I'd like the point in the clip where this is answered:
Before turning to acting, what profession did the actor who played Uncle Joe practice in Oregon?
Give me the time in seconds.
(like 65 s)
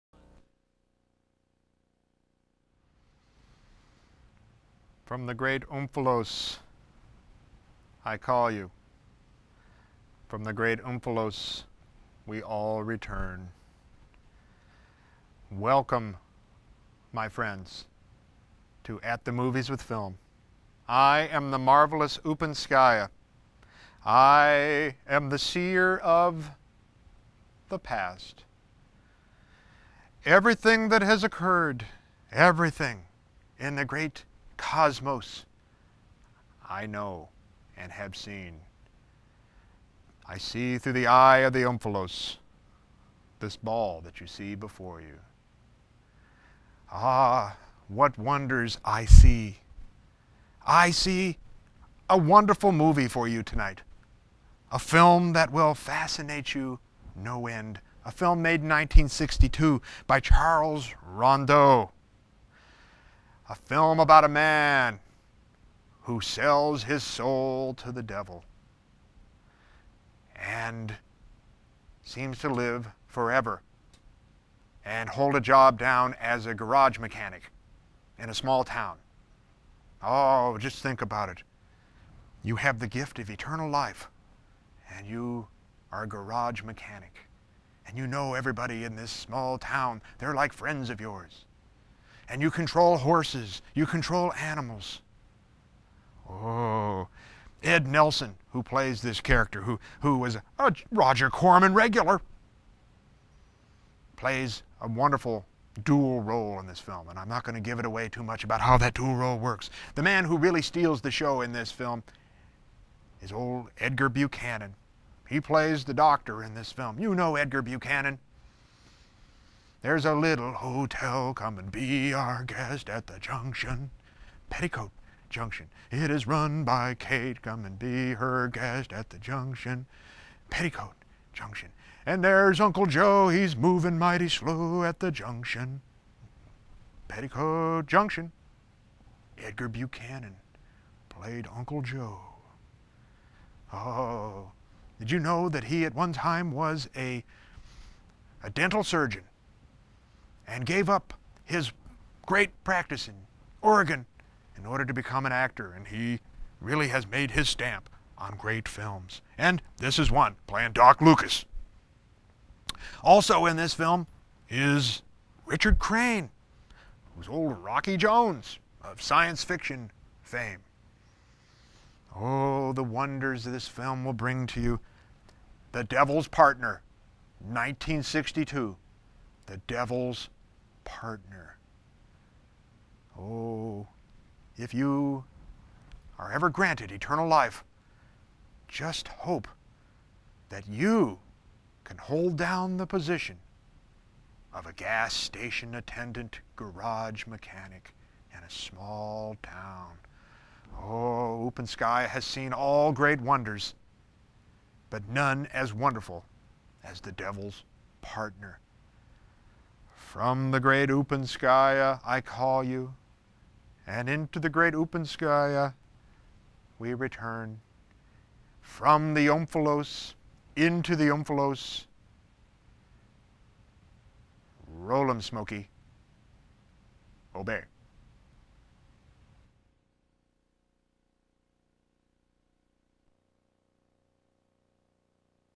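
148 s.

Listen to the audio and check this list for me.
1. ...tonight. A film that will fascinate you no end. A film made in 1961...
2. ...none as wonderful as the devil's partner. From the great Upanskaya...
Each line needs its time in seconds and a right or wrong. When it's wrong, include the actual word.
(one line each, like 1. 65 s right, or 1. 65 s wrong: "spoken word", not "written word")
1. 53 s wrong: "1962", not "1961"
2. 205 s right.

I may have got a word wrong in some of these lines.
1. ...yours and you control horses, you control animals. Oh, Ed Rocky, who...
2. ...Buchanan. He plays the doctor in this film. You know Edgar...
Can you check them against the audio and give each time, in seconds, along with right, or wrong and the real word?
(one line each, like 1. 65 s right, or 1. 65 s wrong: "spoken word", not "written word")
1. 91 s wrong: "Nelson", not "Rocky"
2. 114 s right.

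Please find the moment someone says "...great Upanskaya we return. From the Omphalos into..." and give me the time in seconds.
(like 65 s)
214 s.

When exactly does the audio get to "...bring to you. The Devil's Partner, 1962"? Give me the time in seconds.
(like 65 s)
174 s.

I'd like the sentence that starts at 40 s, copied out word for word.
I see through the eye of the omphalos this ball that you see before you.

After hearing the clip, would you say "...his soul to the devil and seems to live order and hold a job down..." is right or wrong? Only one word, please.
wrong.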